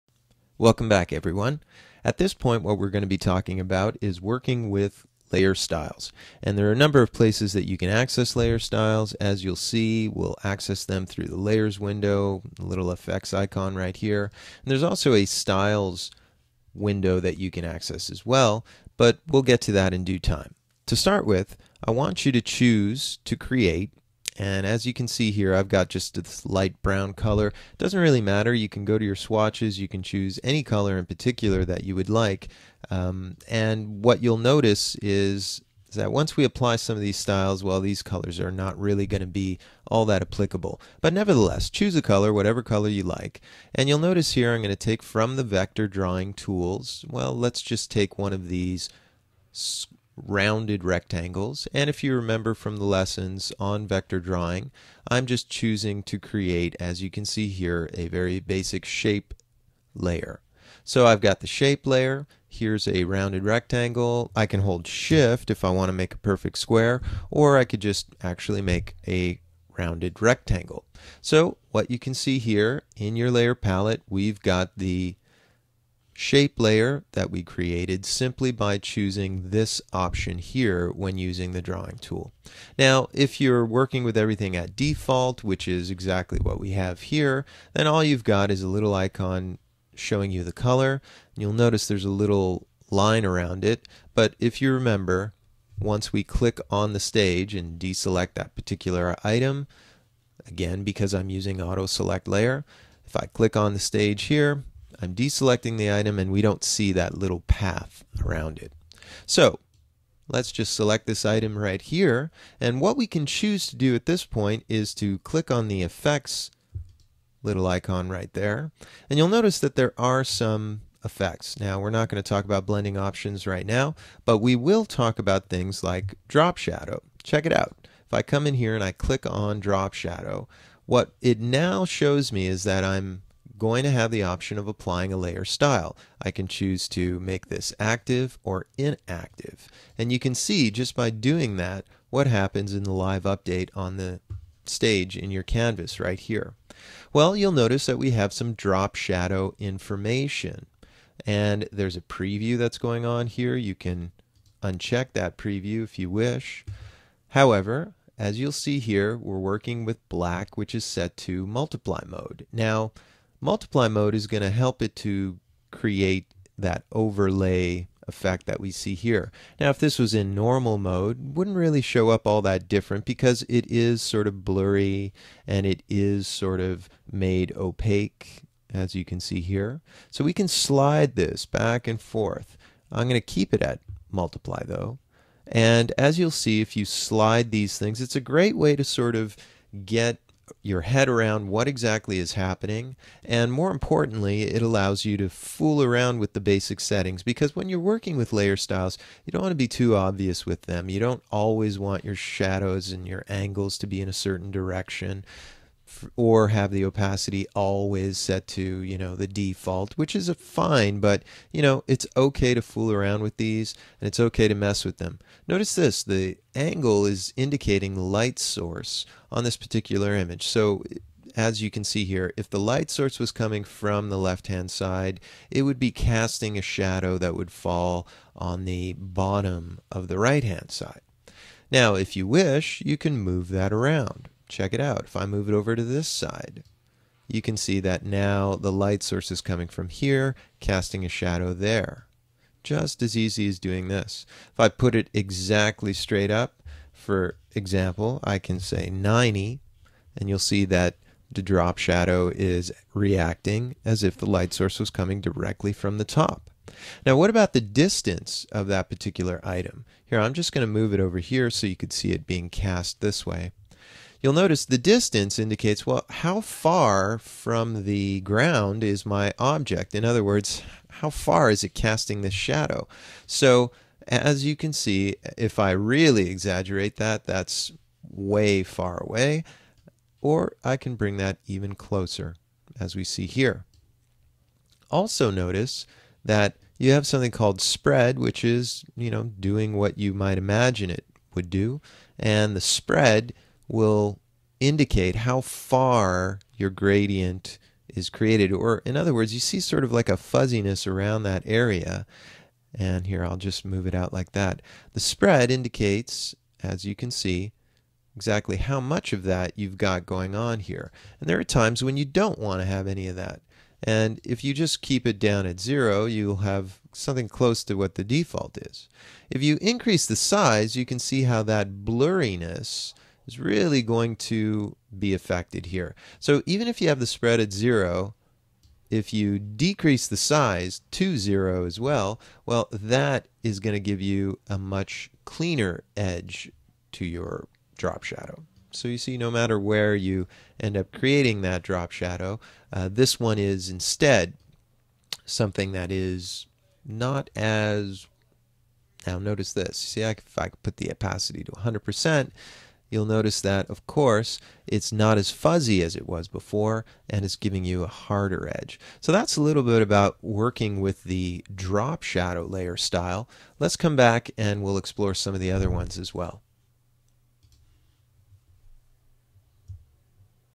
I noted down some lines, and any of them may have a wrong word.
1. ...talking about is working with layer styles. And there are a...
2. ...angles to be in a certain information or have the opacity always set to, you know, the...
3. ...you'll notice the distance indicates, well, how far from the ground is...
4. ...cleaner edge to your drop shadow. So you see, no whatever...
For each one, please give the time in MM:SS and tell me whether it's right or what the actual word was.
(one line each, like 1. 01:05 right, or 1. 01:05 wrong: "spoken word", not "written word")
1. 00:03 right
2. 03:23 wrong: "direction", not "information"
3. 04:24 right
4. 05:35 wrong: "matter", not "whatever".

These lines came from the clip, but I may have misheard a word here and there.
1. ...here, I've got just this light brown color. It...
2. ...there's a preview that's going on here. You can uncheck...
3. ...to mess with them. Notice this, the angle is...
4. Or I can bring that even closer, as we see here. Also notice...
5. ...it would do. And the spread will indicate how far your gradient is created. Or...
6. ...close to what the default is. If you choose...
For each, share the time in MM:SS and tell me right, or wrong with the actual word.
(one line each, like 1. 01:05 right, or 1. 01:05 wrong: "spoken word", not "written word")
1. 00:25 right
2. 02:31 right
3. 03:34 right
4. 04:40 right
5. 04:50 right
6. 05:17 wrong: "increase", not "choose".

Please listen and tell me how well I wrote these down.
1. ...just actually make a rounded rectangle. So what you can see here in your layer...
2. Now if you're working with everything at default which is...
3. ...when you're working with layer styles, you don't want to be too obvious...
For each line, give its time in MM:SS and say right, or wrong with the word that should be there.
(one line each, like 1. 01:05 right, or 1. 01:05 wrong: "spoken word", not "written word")
1. 01:07 right
2. 01:22 right
3. 03:17 right.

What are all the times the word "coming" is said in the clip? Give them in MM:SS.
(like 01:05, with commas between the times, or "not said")
03:43, 03:59, 04:14.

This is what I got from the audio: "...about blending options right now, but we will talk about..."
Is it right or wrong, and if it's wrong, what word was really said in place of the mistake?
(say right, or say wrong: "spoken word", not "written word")
right.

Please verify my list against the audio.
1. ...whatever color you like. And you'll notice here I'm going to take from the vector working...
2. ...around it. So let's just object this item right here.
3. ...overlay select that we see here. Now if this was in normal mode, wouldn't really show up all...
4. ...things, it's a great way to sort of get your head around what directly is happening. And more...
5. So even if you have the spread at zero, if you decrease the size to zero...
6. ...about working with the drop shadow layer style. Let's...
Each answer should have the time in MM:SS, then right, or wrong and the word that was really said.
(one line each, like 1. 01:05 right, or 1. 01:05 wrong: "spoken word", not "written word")
1. 00:42 wrong: "drawing", not "working"
2. 01:48 wrong: "select", not "object"
3. 02:46 wrong: "effect", not "select"
4. 03:07 wrong: "exactly", not "directly"
5. 05:26 right
6. 05:59 right.